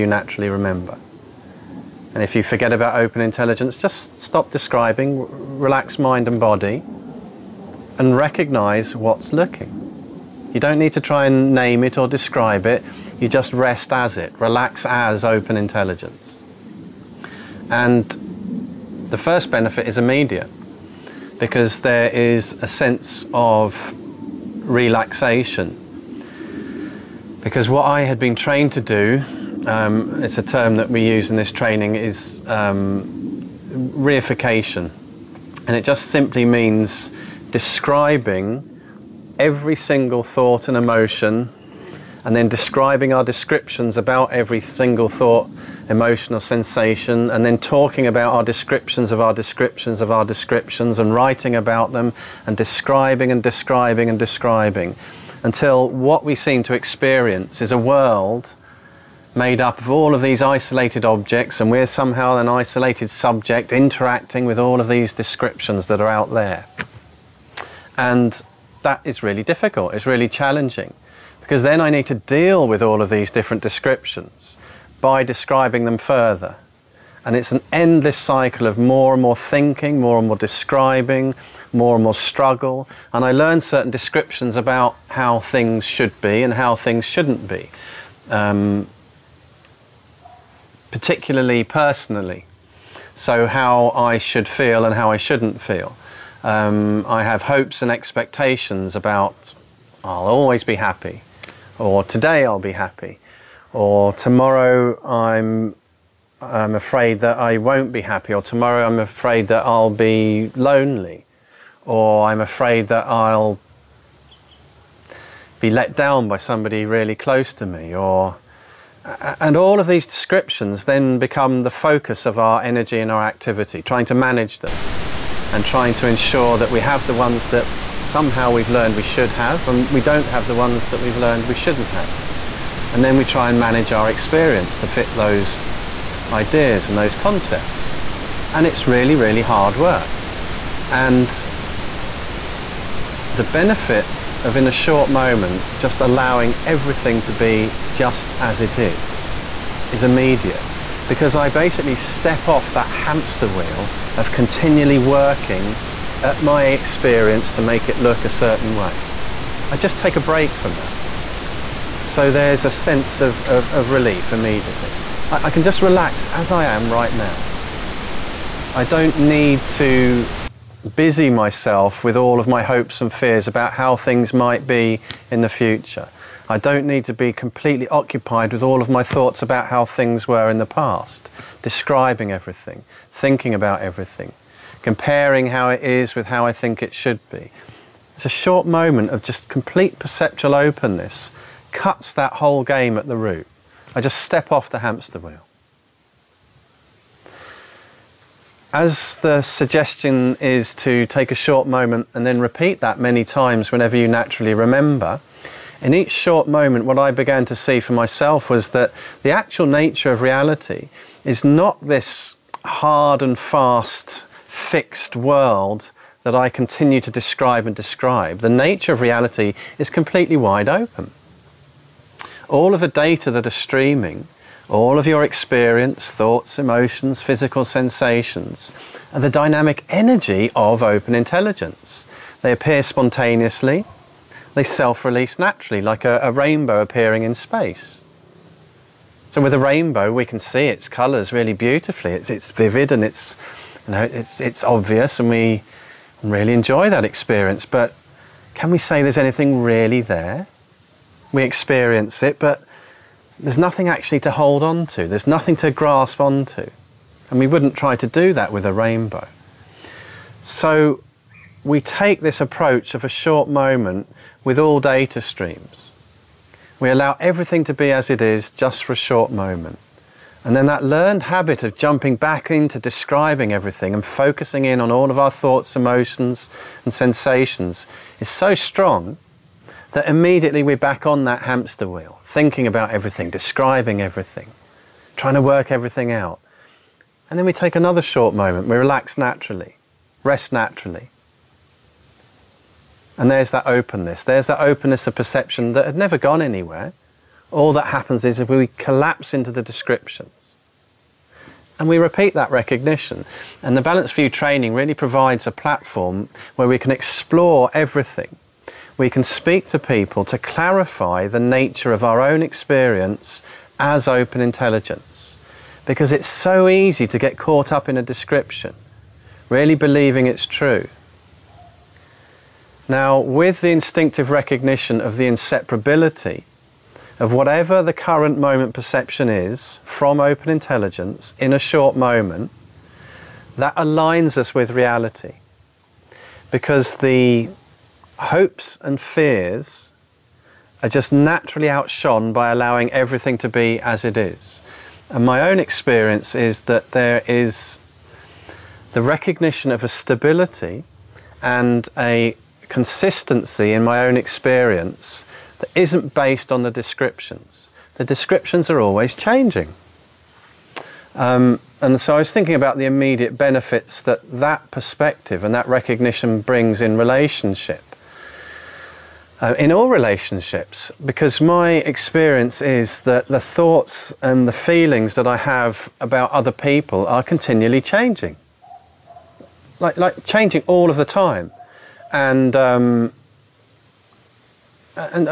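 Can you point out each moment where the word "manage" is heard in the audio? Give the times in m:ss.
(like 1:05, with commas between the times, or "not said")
2:04, 2:13.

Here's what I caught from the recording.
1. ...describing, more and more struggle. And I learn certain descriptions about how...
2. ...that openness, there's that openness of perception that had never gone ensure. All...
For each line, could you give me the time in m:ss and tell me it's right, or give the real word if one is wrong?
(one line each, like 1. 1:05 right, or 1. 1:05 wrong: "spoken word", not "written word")
1. 1:20 right
2. 4:53 wrong: "anywhere", not "ensure".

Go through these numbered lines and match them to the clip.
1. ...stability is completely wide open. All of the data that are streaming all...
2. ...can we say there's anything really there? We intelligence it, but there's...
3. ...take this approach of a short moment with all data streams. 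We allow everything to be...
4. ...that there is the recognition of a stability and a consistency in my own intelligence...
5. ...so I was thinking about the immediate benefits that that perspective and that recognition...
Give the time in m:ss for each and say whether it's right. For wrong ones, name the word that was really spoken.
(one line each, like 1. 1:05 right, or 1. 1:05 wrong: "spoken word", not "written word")
1. 3:38 wrong: "reality", not "stability"
2. 4:08 wrong: "experience", not "intelligence"
3. 4:21 right
4. 5:46 wrong: "experience", not "intelligence"
5. 6:02 right.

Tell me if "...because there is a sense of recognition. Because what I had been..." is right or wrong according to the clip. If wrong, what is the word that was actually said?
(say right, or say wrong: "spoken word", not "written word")
wrong: "relaxation", not "recognition".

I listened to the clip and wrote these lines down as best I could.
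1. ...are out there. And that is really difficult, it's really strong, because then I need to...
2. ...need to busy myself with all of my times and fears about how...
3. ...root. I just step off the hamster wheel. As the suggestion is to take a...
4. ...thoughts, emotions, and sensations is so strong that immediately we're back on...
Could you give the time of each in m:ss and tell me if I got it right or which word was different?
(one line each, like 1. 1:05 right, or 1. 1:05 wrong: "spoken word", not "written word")
1. 1:06 wrong: "challenging", not "strong"
2. 2:49 wrong: "hopes", not "times"
3. 3:13 right
4. 4:35 right.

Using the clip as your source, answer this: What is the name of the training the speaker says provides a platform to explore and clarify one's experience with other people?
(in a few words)
Balanced View.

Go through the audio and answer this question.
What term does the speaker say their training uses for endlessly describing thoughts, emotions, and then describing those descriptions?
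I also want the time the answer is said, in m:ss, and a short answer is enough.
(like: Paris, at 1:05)
reification, at 0:33.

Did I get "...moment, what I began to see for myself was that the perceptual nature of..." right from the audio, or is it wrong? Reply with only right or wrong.
wrong.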